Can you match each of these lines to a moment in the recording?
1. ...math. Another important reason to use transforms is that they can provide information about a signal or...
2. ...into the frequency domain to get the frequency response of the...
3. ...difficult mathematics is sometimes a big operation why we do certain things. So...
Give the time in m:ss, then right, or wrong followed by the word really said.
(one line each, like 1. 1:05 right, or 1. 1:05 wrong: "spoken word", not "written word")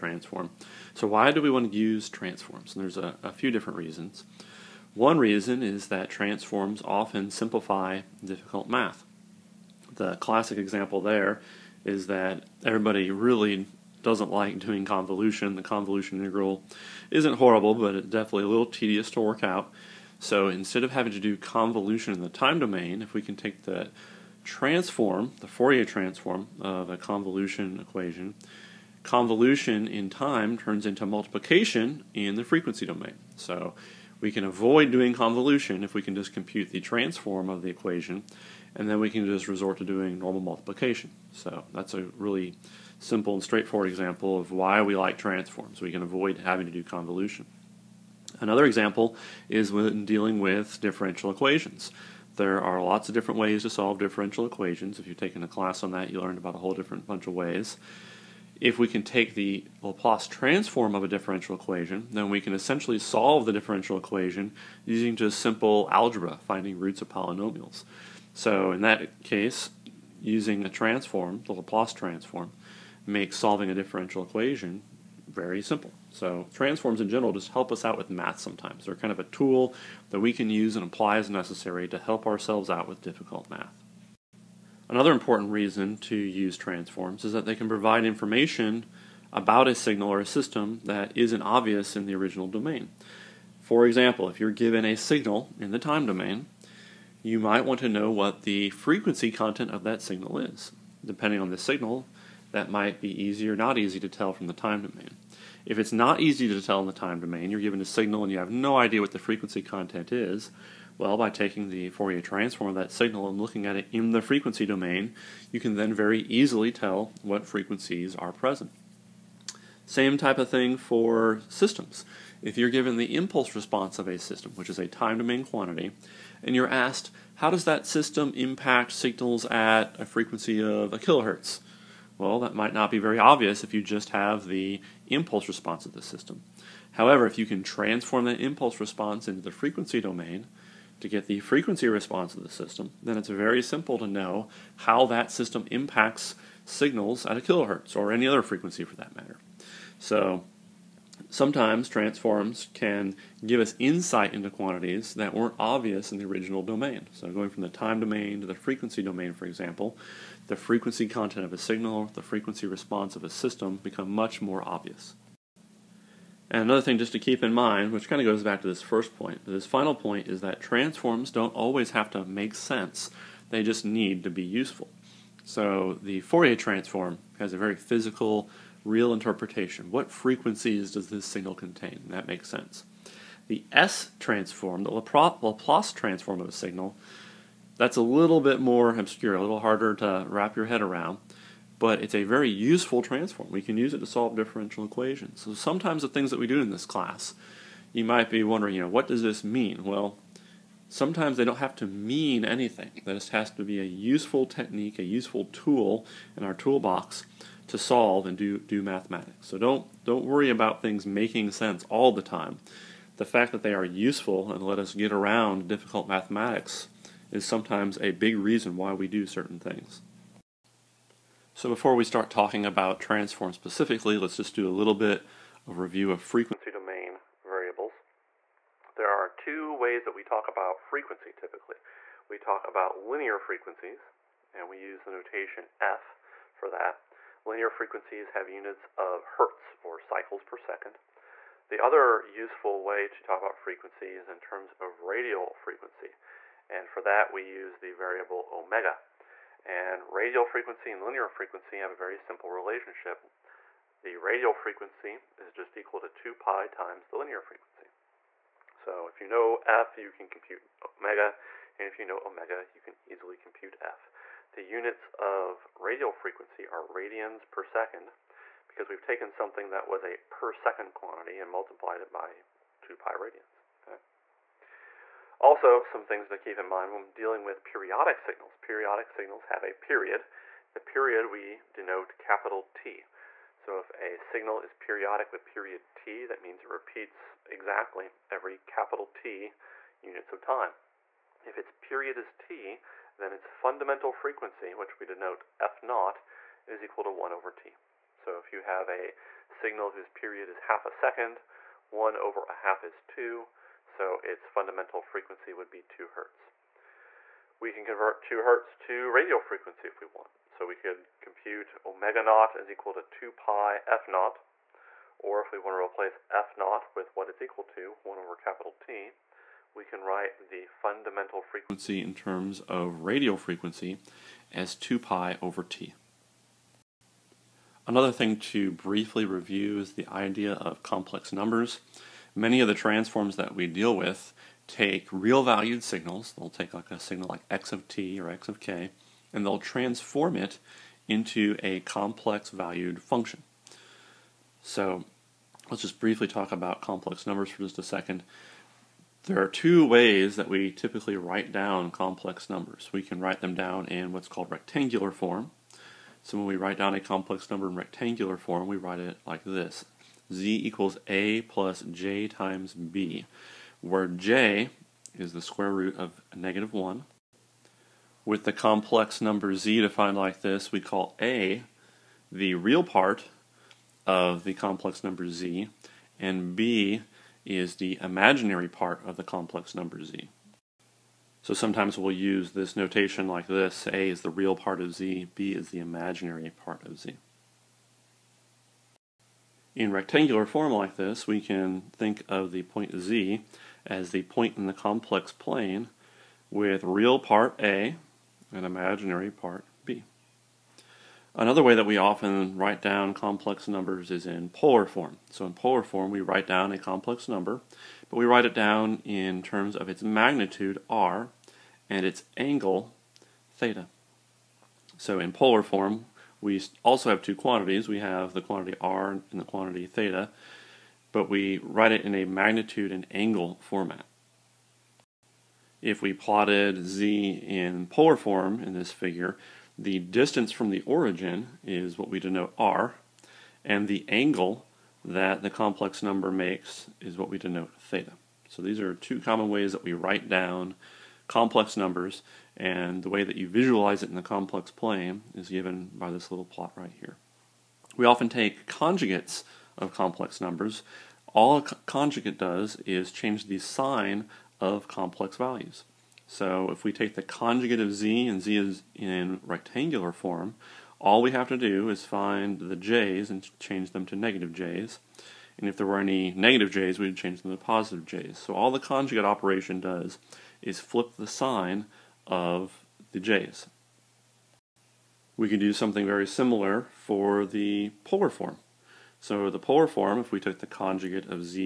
1. 1:23 right
2. 2:19 right
3. 3:35 wrong: "reason", not "operation".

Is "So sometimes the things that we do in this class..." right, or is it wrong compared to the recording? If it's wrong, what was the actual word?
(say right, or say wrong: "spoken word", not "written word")
right.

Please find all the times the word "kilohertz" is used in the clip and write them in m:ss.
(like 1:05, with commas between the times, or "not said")
2:10, 2:27.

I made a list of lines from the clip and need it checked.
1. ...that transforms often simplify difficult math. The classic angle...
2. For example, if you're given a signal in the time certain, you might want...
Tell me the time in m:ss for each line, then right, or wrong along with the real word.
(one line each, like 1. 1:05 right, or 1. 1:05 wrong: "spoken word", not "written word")
1. 0:05 wrong: "example", not "angle"
2. 1:33 wrong: "domain", not "certain".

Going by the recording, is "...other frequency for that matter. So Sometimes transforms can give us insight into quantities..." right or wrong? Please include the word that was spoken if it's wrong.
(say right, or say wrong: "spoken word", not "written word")
right.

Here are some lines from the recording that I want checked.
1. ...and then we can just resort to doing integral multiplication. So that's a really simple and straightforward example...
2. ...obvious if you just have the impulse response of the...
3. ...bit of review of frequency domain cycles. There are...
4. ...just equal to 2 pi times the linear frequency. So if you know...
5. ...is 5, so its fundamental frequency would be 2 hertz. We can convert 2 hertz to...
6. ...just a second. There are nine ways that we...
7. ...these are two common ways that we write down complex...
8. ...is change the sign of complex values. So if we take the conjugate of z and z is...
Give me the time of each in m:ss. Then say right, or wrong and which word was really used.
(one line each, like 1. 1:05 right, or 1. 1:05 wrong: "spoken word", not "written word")
1. 0:38 wrong: "normal", not "integral"
2. 2:13 right
3. 3:44 wrong: "variables", not "cycles"
4. 4:15 right
5. 5:02 wrong: "2", not "5"
6. 5:47 wrong: "two", not "nine"
7. 7:18 right
8. 7:32 right.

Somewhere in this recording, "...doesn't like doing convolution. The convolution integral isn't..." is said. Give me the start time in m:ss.
0:14.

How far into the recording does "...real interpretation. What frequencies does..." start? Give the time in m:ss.
2:58.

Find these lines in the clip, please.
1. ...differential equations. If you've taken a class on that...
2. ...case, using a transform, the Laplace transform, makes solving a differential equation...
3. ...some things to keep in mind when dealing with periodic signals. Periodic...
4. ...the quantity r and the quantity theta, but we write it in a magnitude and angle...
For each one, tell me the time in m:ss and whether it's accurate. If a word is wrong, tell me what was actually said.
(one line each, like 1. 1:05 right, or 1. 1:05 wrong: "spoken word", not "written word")
1. 0:53 right
2. 1:09 right
3. 4:35 right
4. 6:58 right.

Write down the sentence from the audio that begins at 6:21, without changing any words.
So sometimes we'll use this notation like this, A is the real part of z, B is the imaginary part of z.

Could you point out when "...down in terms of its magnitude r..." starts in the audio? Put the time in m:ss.
6:48.